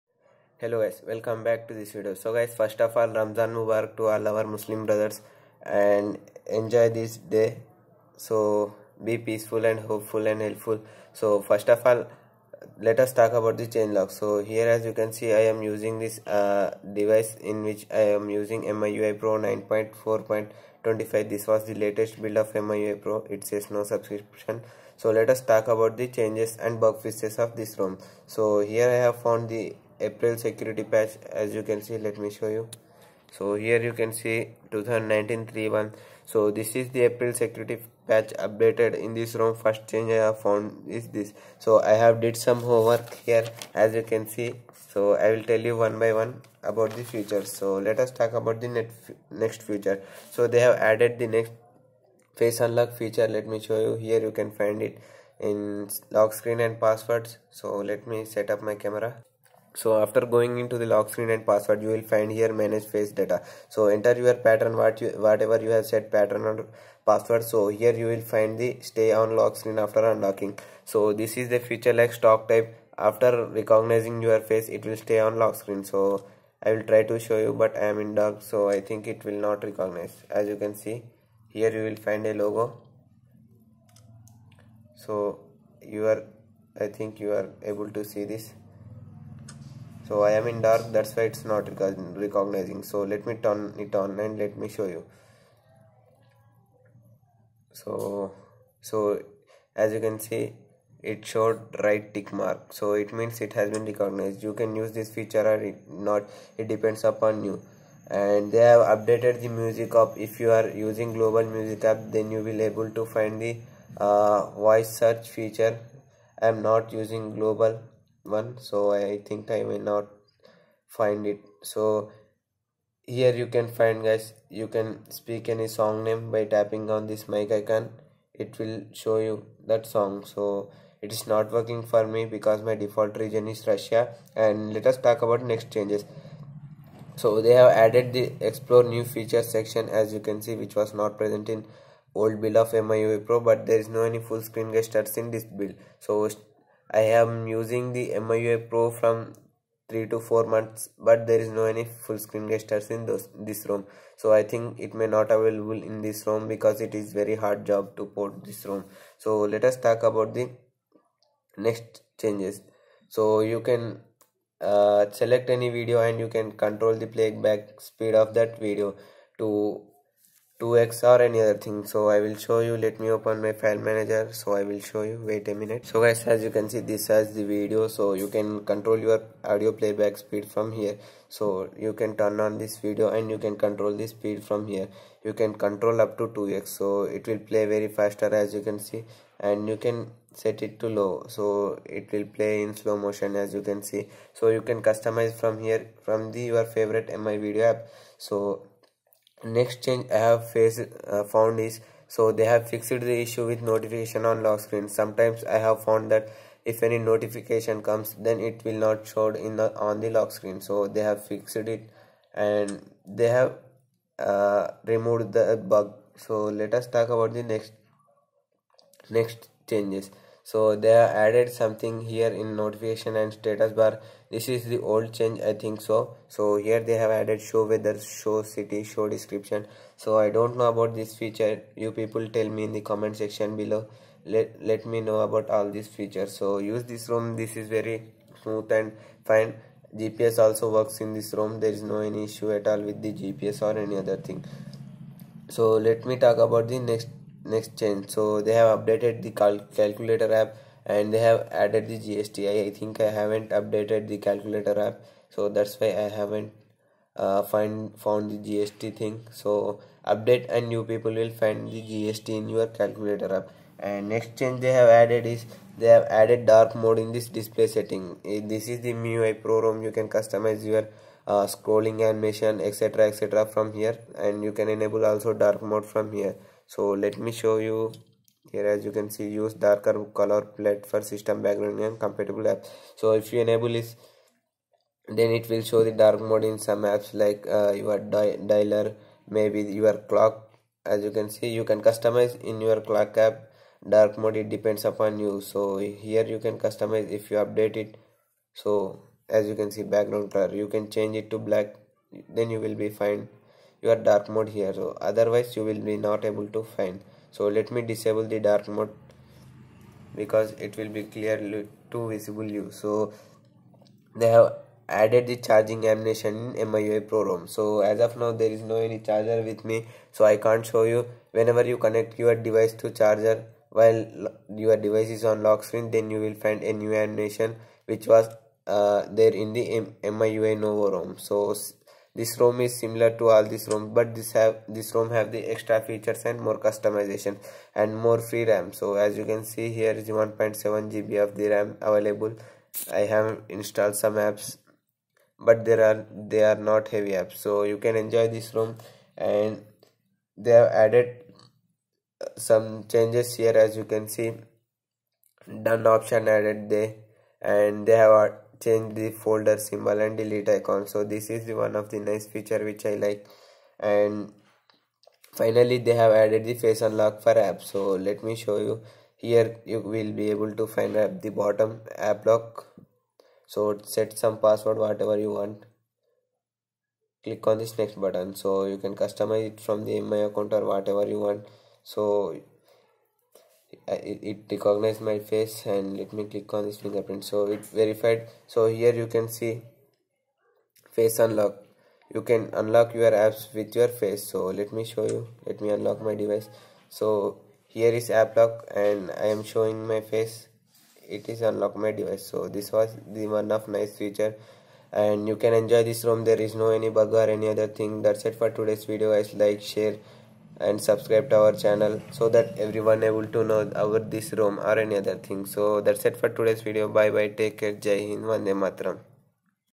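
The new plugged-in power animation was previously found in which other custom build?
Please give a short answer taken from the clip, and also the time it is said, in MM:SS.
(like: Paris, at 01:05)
MIUI Novo, at 05:30.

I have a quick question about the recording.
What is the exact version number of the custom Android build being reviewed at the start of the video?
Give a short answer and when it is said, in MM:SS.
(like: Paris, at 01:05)
9.4.25, at 00:19.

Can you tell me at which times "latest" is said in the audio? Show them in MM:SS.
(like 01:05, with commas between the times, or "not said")
00:21.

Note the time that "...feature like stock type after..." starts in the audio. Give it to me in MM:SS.
01:11.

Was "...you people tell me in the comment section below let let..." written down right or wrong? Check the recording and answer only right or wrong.
right.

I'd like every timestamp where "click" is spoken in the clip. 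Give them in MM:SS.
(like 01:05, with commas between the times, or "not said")
06:17, 06:26.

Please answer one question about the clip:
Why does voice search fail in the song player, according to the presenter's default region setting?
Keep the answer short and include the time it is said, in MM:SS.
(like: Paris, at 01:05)
Russia, at 02:13.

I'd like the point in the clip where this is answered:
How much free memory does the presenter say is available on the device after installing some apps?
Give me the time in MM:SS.
05:40.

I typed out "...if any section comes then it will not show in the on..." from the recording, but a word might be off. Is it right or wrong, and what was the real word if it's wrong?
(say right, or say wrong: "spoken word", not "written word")
wrong: "notification", not "section".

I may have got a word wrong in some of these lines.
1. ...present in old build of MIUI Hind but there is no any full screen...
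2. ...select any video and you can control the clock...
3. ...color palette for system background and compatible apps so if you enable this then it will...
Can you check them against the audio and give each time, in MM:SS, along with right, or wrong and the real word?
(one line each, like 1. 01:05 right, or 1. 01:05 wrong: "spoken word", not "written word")
1. 02:21 wrong: "Pro", not "Hind"
2. 02:45 wrong: "playback", not "clock"
3. 04:40 right.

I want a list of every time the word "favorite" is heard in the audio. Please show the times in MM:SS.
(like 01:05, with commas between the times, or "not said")
03:16.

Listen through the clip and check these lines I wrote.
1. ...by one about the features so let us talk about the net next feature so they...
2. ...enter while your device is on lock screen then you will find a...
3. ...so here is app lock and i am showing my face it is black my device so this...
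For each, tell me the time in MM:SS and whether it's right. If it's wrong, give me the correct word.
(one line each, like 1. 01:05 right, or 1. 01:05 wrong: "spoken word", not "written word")
1. 00:45 right
2. 05:22 wrong: "charger", not "enter"
3. 06:36 wrong: "unlock", not "black".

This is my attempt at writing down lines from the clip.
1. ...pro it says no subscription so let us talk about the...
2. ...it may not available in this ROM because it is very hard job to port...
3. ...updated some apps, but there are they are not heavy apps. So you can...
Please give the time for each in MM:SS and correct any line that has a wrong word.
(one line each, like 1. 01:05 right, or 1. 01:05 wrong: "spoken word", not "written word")
1. 00:23 right
2. 02:34 right
3. 05:43 wrong: "installed", not "updated".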